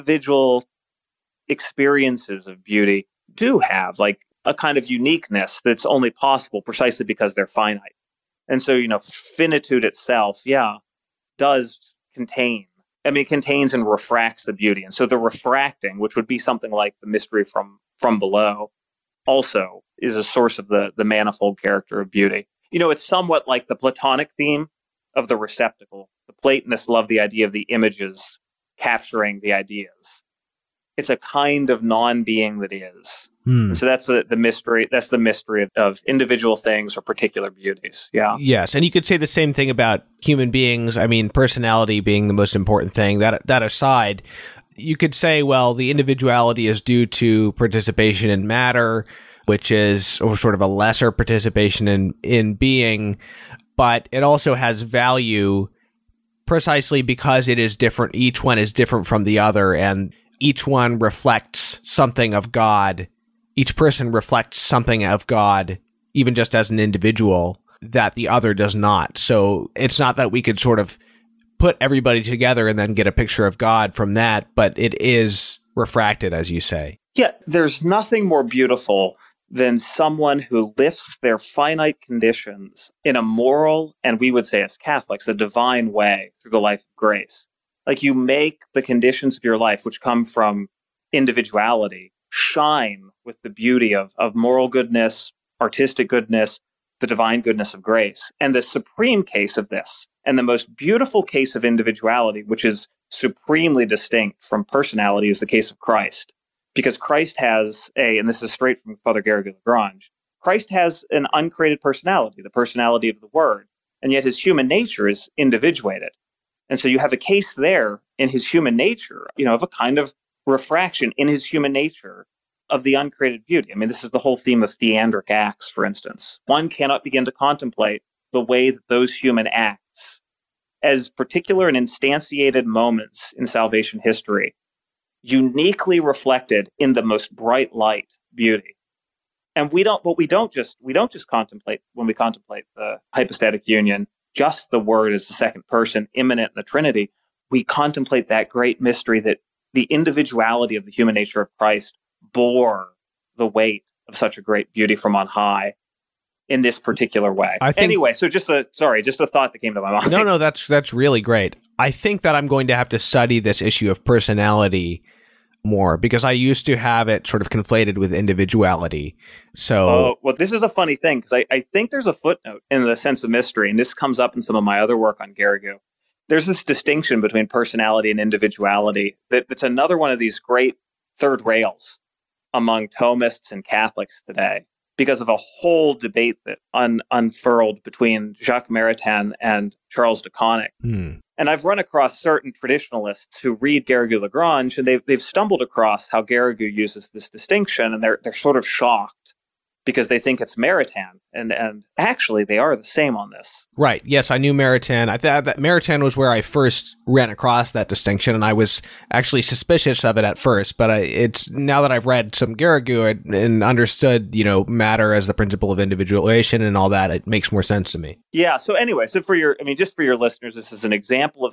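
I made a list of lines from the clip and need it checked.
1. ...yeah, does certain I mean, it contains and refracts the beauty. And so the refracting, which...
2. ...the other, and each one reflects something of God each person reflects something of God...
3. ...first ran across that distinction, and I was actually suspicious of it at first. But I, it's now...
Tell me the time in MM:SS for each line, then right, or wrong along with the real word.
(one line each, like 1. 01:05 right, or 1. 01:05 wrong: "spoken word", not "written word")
1. 00:10 wrong: "contain", not "certain"
2. 00:59 right
3. 03:26 right.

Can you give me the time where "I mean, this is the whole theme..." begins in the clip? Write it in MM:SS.
02:03.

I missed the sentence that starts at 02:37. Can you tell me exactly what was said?
I think, anyway, so just a sorry, just a thought that came to my mind.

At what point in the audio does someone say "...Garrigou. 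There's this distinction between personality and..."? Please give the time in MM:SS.
02:55.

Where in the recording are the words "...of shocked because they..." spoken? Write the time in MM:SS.
03:18.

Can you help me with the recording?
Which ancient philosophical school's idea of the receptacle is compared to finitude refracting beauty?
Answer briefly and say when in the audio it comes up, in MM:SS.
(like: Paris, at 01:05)
Platonic, at 00:23.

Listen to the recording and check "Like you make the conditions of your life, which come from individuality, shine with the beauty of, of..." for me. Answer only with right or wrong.
right.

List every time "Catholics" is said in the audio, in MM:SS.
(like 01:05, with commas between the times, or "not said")
01:24, 03:03.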